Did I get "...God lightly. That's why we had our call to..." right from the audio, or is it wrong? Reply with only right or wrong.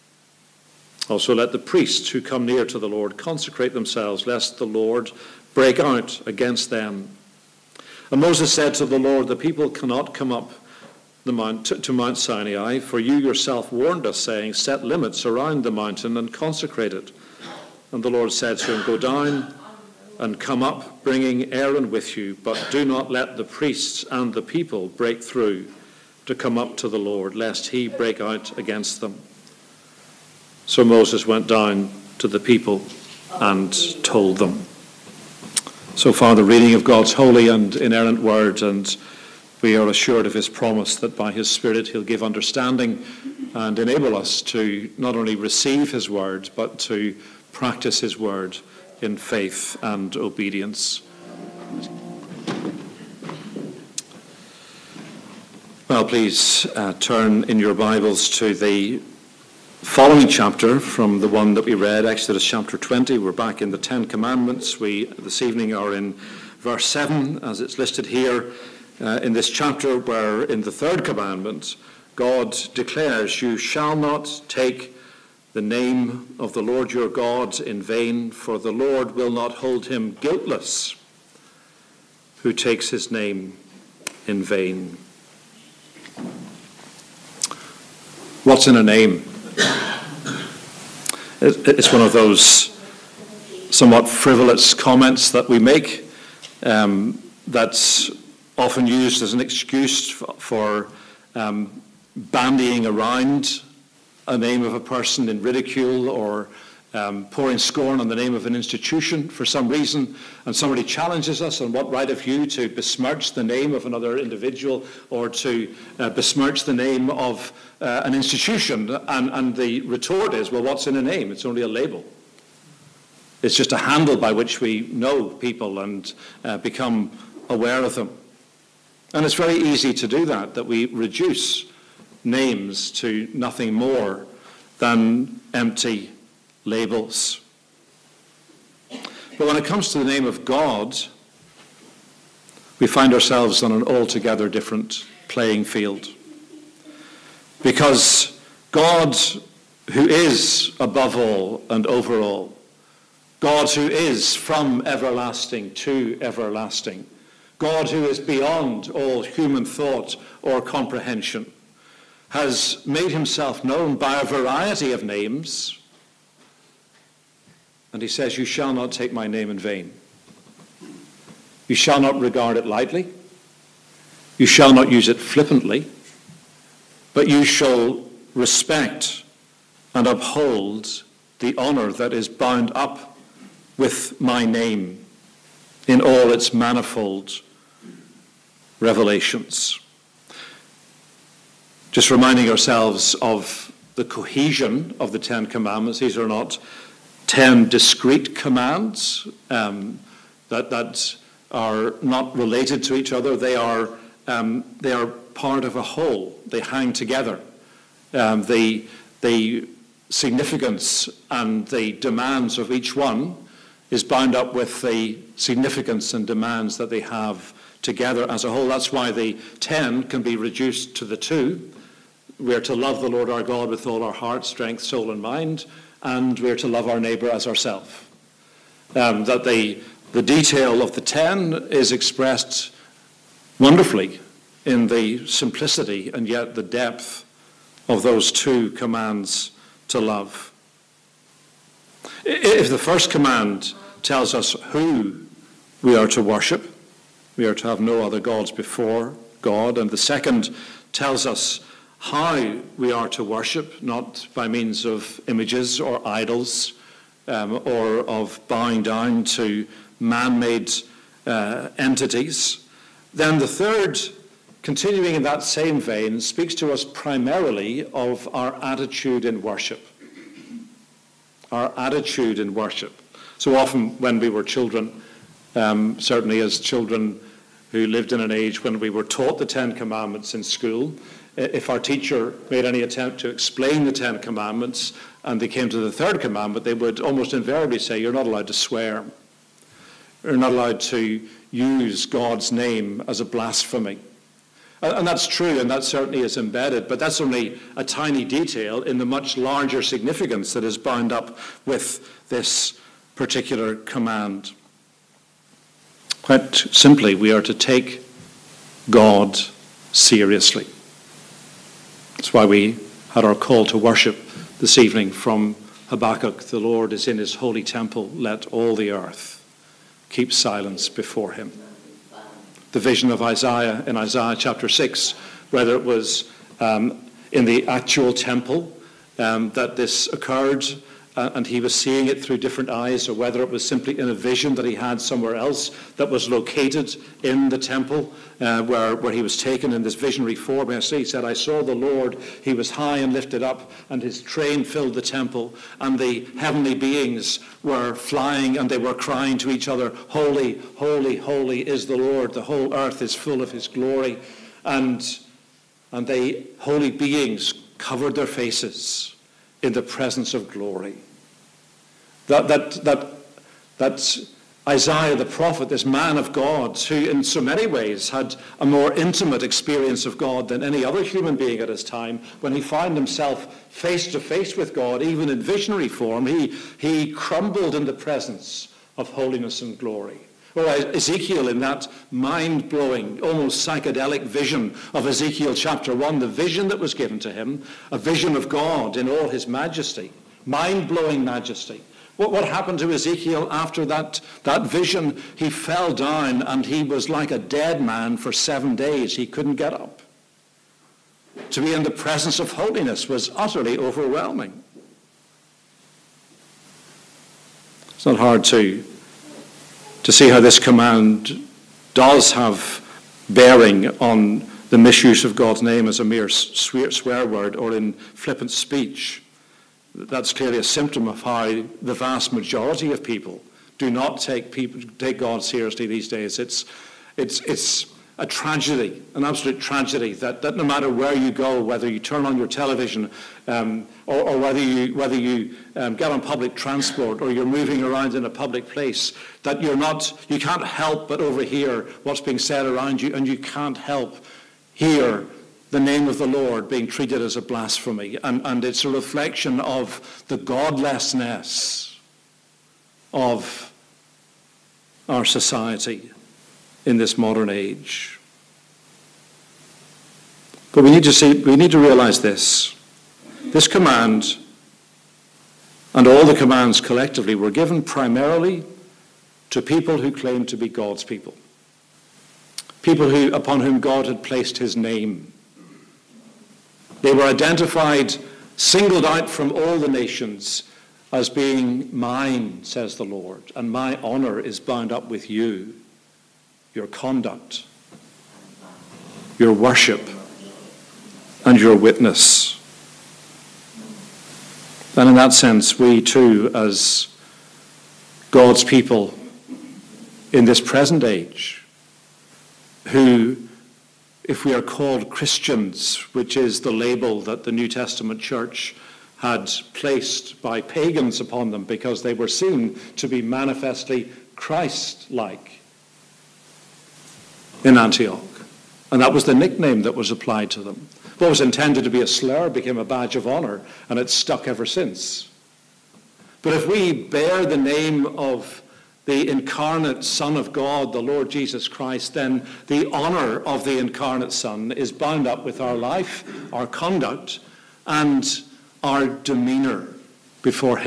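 wrong.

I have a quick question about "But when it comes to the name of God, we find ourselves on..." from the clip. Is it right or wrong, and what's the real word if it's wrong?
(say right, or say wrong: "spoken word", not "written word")
right.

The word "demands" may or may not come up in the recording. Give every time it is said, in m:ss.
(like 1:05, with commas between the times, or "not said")
3:31, 3:36.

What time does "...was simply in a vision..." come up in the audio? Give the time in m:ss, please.
5:33.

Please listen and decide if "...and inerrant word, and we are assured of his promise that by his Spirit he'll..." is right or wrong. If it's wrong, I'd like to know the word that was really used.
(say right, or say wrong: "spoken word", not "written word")
right.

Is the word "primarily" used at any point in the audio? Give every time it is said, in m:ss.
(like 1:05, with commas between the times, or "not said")
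4:26, 7:47.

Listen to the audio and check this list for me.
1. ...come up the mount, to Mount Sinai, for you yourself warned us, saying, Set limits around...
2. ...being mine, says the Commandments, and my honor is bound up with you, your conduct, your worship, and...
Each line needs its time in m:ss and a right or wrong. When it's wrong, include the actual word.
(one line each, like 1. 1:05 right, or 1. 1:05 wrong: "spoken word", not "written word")
1. 0:10 right
2. 8:01 wrong: "Lord", not "Commandments".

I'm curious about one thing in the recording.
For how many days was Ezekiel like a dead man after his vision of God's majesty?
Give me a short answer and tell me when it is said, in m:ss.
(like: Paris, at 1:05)
7, at 6:38.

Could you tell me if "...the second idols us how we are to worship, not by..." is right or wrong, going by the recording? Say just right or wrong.
wrong.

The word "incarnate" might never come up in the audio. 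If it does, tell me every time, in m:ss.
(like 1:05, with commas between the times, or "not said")
8:49, 8:53.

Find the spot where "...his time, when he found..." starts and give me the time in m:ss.
6:11.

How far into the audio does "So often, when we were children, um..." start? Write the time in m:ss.
4:33.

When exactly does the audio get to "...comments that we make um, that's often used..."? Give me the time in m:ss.
1:34.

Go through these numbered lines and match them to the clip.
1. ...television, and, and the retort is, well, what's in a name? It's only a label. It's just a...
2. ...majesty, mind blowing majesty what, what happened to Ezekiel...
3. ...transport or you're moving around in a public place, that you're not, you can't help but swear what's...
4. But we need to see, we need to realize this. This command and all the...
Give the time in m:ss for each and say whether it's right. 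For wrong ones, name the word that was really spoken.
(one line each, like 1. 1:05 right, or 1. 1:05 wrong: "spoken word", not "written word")
1. 1:58 wrong: "institution", not "television"
2. 6:29 right
3. 7:16 wrong: "overhear", not "swear"
4. 7:40 right.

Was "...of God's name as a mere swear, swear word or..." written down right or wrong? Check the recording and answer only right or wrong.
right.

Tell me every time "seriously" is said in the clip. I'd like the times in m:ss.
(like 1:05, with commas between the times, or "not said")
5:09, 7:05.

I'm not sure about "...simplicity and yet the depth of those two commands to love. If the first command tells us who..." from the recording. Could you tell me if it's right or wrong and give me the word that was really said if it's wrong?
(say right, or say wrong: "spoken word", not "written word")
right.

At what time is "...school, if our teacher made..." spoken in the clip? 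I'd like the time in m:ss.
4:40.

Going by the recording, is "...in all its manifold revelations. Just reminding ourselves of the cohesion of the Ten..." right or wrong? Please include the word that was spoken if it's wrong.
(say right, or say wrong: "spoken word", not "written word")
right.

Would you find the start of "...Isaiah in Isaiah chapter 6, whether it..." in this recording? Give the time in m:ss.
5:23.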